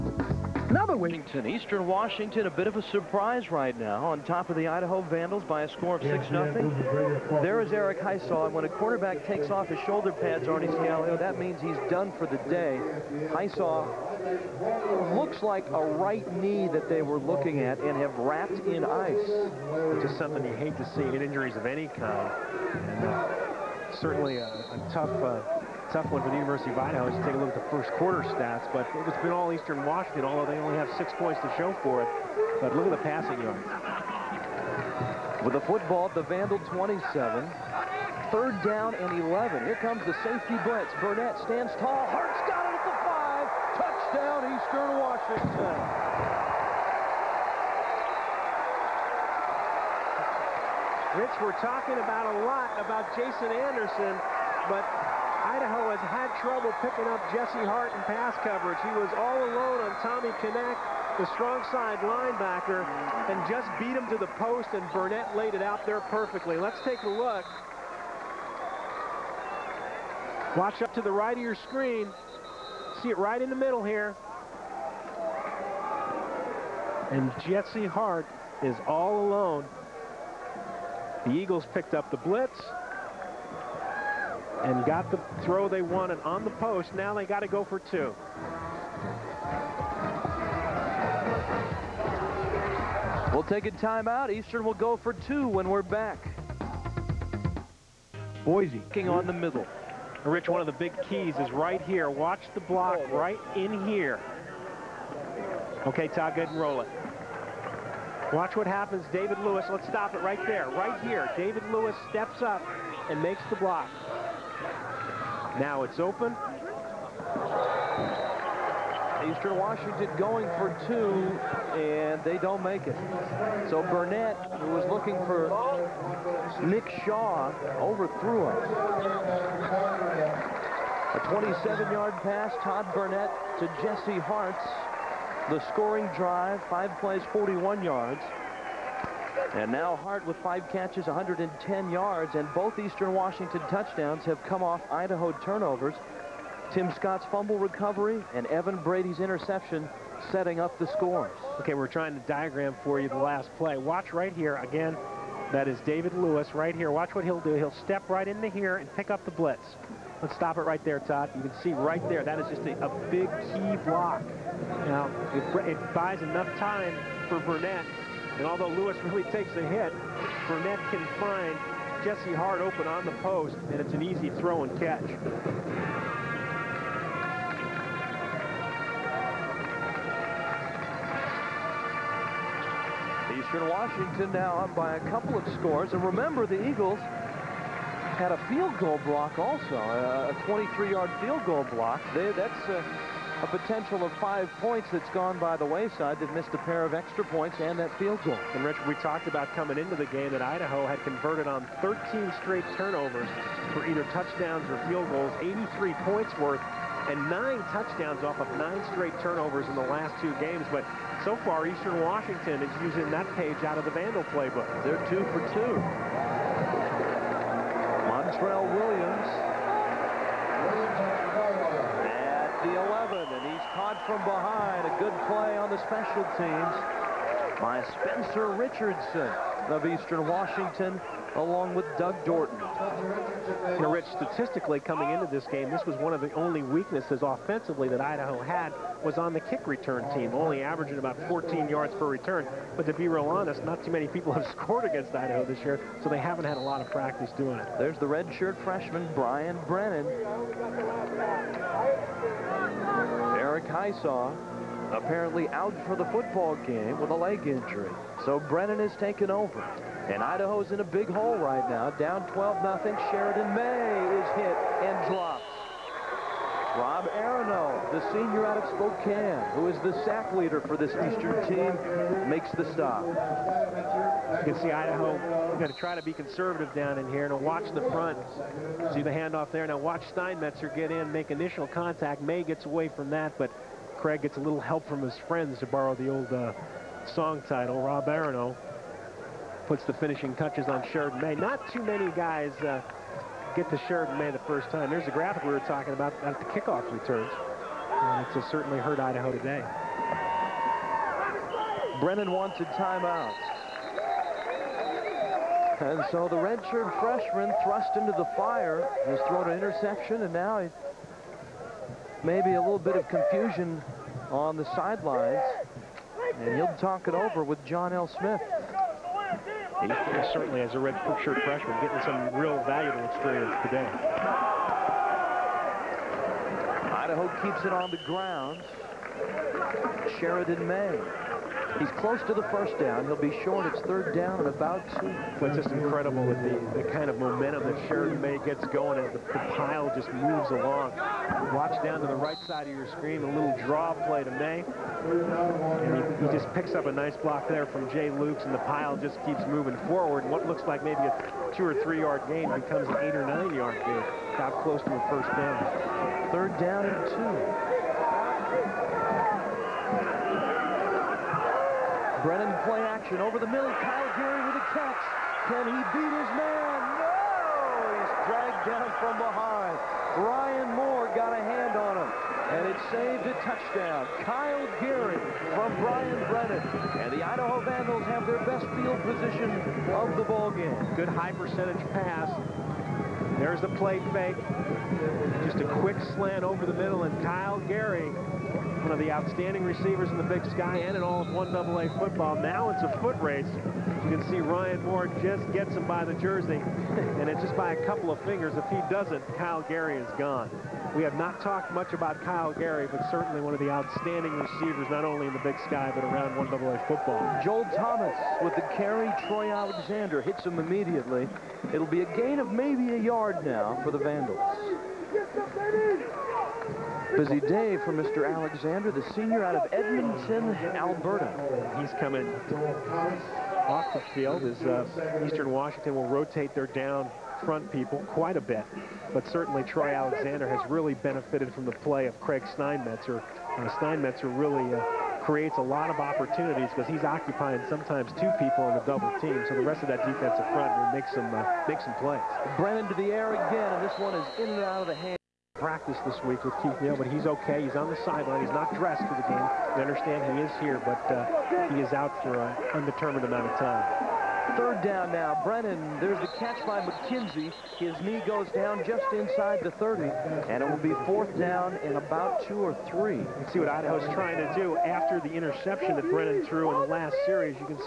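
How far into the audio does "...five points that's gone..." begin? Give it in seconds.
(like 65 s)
194 s.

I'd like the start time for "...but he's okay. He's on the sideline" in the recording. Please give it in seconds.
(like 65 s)
446 s.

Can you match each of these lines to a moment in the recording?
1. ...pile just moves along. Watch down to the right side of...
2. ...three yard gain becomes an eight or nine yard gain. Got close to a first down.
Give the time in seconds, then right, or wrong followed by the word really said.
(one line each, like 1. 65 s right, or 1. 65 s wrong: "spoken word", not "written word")
1. 339 s right
2. 351 s right.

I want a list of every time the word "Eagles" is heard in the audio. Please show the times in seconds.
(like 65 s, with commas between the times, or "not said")
81 s, 186 s.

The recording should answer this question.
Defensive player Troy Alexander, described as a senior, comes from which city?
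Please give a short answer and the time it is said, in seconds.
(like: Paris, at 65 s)
Edmonton, Alberta, at 419 s.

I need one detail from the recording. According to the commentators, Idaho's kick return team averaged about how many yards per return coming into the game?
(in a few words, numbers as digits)
14.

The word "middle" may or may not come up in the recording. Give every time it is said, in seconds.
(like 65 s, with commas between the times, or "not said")
73 s, 99 s, 363 s, 386 s.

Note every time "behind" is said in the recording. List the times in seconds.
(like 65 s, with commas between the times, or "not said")
224 s, 369 s.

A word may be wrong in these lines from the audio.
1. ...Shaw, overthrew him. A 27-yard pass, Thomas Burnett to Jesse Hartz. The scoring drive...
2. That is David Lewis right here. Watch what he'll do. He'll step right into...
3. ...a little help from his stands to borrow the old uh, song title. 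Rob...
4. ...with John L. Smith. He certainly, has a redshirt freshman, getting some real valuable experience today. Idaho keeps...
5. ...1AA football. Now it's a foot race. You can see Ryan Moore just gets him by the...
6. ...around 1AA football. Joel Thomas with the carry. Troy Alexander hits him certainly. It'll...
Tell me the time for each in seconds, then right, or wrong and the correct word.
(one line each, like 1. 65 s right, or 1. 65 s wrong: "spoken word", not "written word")
1. 127 s wrong: "Todd", not "Thomas"
2. 155 s right
3. 284 s wrong: "friends", not "stands"
4. 317 s right
5. 391 s right
6. 406 s wrong: "immediately", not "certainly".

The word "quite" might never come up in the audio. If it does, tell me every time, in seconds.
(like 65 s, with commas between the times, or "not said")
428 s.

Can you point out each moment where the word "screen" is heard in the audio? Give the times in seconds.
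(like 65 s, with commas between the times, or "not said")
71 s, 342 s.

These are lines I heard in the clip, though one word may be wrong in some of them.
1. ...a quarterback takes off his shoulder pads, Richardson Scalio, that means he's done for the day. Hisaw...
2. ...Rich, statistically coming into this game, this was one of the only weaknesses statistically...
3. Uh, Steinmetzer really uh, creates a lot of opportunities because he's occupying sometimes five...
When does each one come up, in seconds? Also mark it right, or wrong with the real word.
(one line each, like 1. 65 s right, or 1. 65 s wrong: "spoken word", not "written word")
1. 8 s wrong: "Arnie", not "Richardson"
2. 233 s wrong: "offensively", not "statistically"
3. 433 s wrong: "two", not "five".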